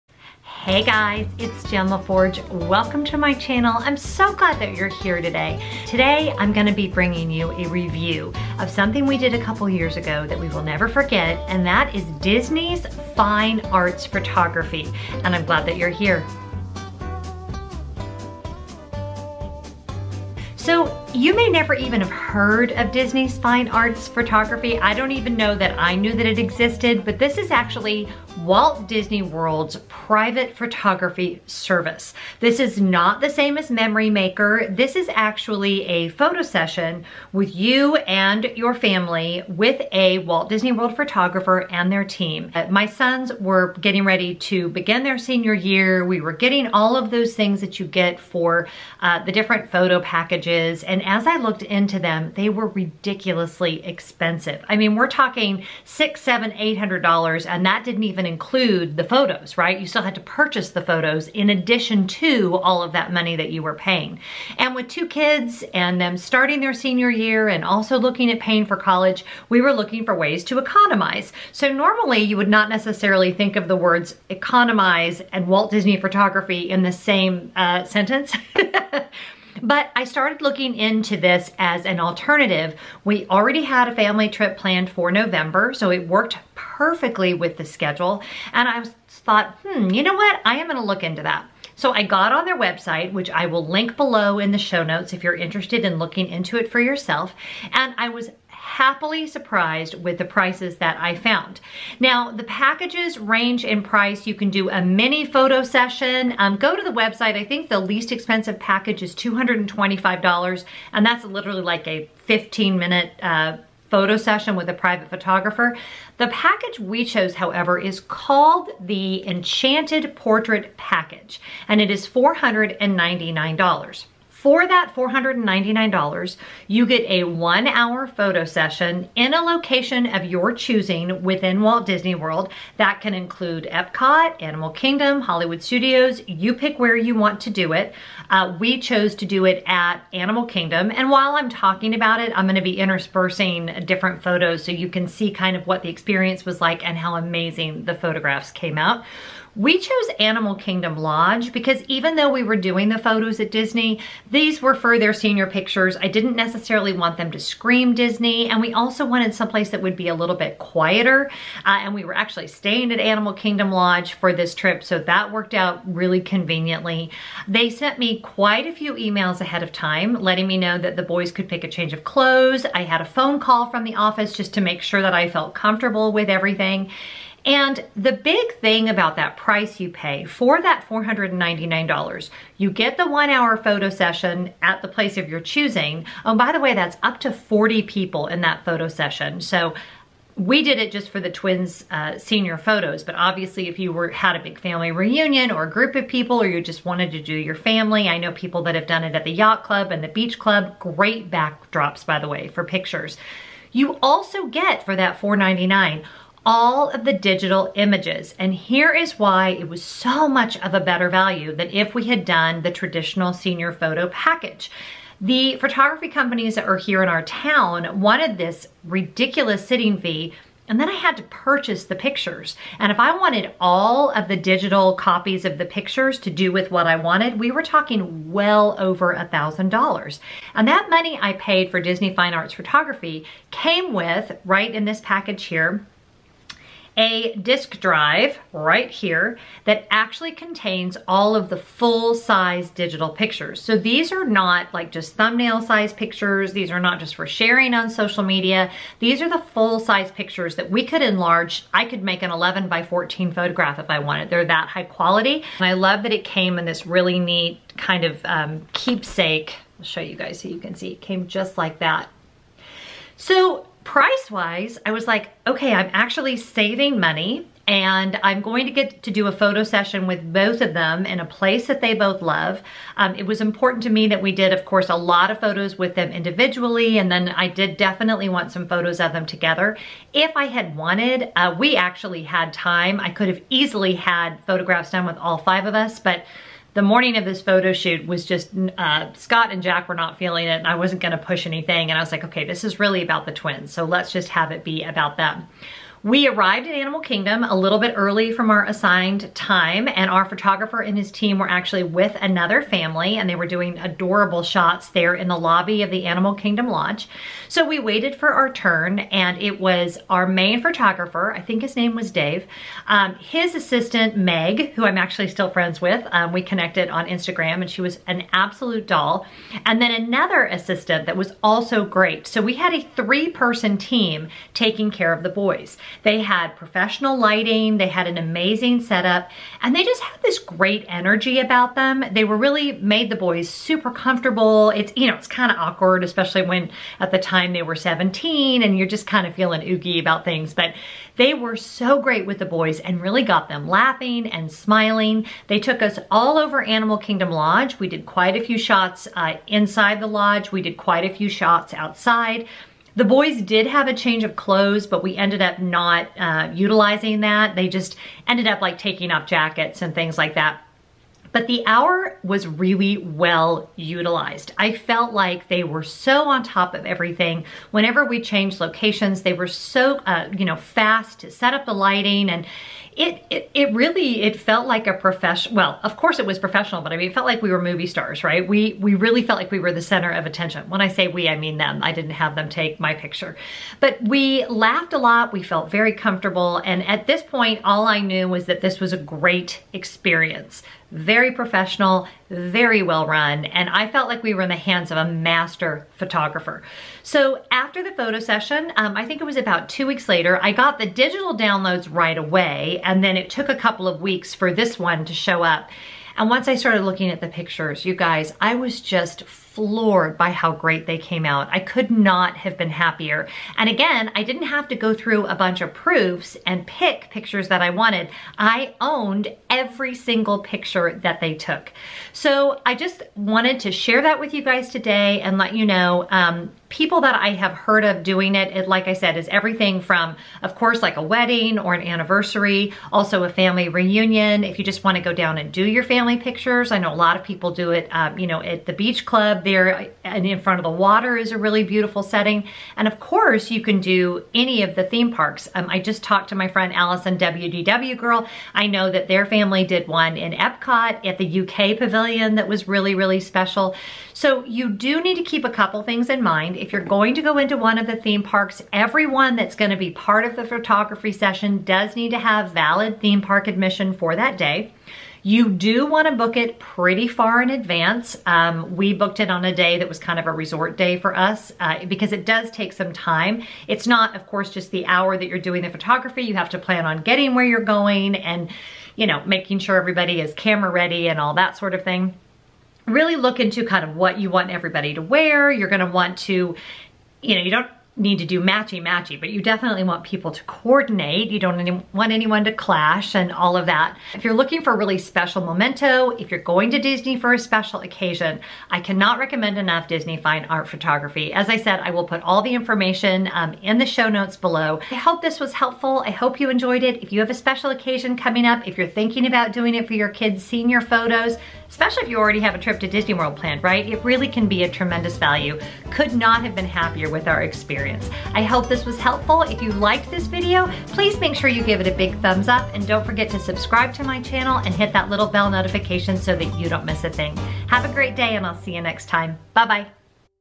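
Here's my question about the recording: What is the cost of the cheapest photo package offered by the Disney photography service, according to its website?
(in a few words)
$225.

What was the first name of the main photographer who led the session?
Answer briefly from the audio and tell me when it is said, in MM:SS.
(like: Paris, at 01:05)
Dave, at 05:12.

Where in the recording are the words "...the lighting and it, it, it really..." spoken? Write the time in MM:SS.
06:11.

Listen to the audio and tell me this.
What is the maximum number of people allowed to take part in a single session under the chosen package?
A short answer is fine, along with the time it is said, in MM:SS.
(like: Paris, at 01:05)
40, at 03:07.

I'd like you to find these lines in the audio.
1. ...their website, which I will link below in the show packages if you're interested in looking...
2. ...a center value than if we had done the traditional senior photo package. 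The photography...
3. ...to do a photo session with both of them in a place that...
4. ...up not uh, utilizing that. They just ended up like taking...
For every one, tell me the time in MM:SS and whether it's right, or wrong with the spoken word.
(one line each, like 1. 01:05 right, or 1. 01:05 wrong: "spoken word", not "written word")
1. 01:32 wrong: "notes", not "packages"
2. 03:30 wrong: "better", not "center"
3. 04:29 right
4. 05:55 right.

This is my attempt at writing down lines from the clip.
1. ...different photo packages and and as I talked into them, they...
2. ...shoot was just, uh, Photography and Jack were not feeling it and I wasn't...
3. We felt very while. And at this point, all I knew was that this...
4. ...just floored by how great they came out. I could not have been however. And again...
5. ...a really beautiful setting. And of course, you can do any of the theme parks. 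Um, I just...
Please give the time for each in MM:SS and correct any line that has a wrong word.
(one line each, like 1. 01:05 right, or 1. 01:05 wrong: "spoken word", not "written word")
1. 00:49 wrong: "looked", not "talked"
2. 04:47 wrong: "Scott", not "Photography"
3. 06:25 wrong: "comfortable", not "while"
4. 06:48 wrong: "happier", not "however"
5. 07:21 right.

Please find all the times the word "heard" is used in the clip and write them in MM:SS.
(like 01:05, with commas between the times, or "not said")
00:22, 07:07.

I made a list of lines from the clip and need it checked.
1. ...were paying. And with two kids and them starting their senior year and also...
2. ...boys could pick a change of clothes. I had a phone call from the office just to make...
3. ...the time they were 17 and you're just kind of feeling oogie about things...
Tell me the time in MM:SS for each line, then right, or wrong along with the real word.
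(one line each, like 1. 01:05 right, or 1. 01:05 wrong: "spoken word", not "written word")
1. 01:03 right
2. 02:51 right
3. 05:37 right.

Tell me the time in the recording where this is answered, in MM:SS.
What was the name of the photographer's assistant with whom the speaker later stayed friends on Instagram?
05:14.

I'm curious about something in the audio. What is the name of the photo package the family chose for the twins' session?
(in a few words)
Enchanted Portrait Package.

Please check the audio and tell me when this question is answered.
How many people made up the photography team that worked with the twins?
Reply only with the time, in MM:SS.
05:22.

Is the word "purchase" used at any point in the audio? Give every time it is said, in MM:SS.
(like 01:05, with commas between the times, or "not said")
01:00, 03:41.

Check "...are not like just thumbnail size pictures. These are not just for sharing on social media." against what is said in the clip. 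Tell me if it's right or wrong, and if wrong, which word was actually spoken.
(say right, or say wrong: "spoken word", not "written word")
right.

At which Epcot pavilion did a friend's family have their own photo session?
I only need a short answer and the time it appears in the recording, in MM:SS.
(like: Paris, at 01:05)
UK Pavilion, at 07:31.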